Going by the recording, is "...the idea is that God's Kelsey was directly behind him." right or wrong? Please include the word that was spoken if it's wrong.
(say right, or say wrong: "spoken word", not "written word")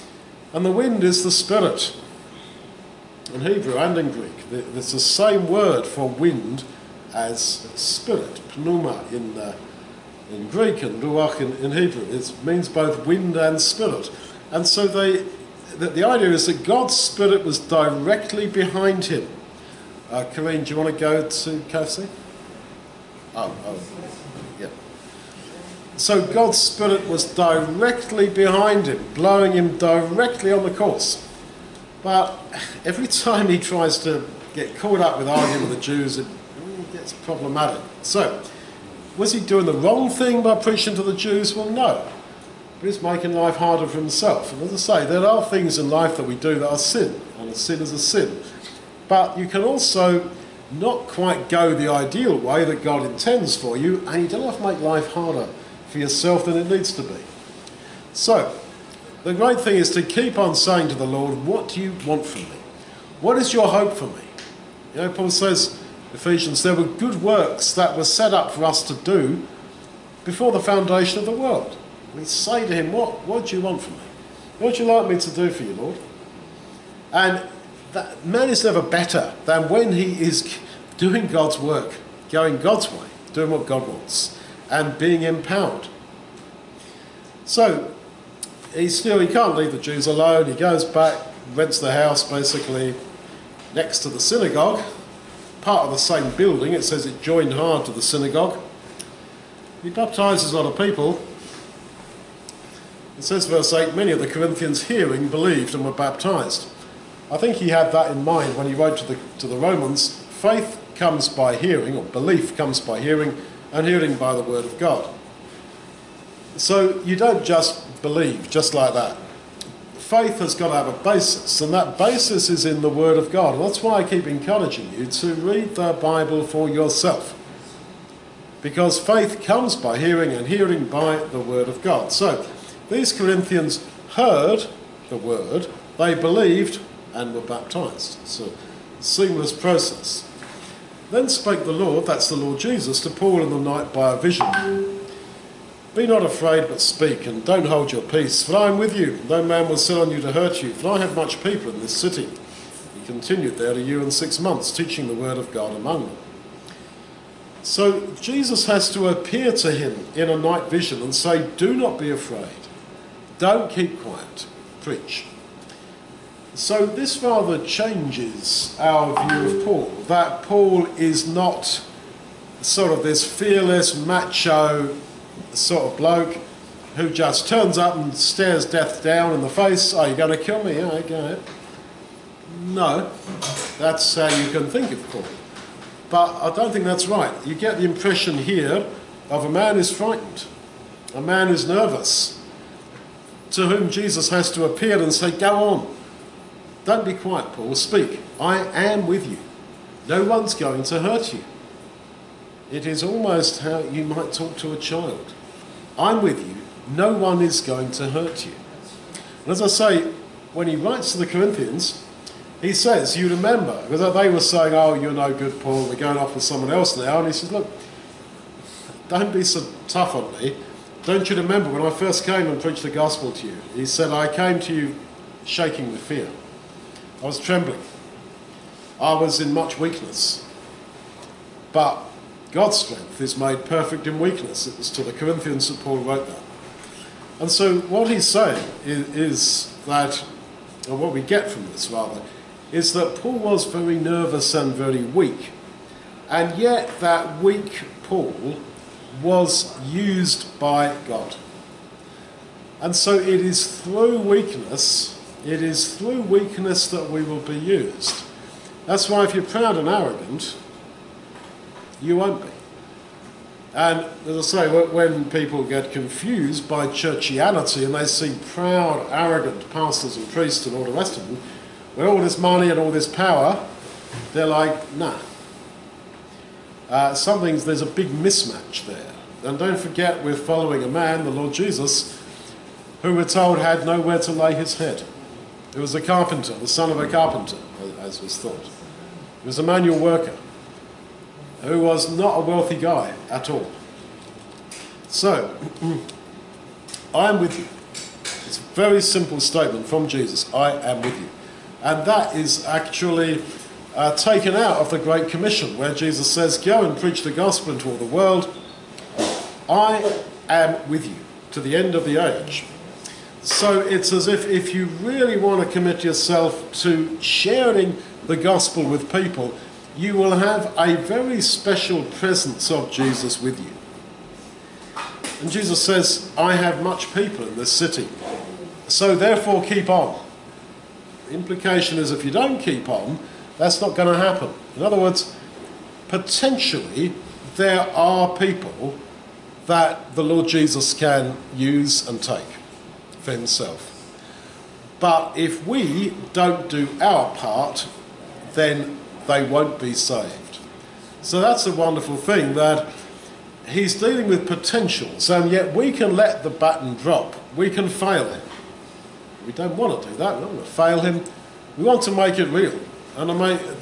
wrong: "Spirit", not "Kelsey".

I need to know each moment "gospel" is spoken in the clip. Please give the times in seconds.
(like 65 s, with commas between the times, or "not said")
222 s, 307 s, 318 s.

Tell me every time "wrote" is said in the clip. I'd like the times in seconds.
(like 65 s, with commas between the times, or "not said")
108 s, 235 s.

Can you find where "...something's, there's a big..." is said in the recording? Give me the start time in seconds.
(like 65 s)
277 s.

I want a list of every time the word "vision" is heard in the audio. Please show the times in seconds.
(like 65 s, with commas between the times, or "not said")
144 s, 160 s.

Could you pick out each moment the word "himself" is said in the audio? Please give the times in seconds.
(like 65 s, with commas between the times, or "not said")
43 s, 343 s.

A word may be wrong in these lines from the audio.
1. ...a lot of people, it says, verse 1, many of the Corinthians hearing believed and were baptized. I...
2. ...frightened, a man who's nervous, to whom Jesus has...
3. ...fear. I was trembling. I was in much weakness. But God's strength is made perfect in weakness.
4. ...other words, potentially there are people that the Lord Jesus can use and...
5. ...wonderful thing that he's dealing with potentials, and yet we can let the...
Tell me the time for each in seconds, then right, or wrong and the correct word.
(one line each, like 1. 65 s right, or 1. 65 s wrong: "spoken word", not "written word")
1. 100 s wrong: "8", not "1"
2. 189 s right
3. 226 s right
4. 334 s right
5. 351 s right.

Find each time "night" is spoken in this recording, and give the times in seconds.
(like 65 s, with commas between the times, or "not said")
143 s, 160 s.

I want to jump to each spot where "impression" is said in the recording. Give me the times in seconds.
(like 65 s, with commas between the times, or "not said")
187 s.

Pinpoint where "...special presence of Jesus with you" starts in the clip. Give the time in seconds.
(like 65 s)
321 s.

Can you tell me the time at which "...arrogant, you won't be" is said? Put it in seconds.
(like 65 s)
259 s.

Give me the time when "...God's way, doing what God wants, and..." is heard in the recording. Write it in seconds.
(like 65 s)
82 s.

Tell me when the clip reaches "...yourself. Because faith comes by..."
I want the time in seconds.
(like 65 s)
126 s.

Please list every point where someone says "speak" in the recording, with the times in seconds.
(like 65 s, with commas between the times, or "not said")
146 s, 197 s.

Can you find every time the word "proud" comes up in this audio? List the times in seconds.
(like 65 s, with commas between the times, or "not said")
259 s, 268 s.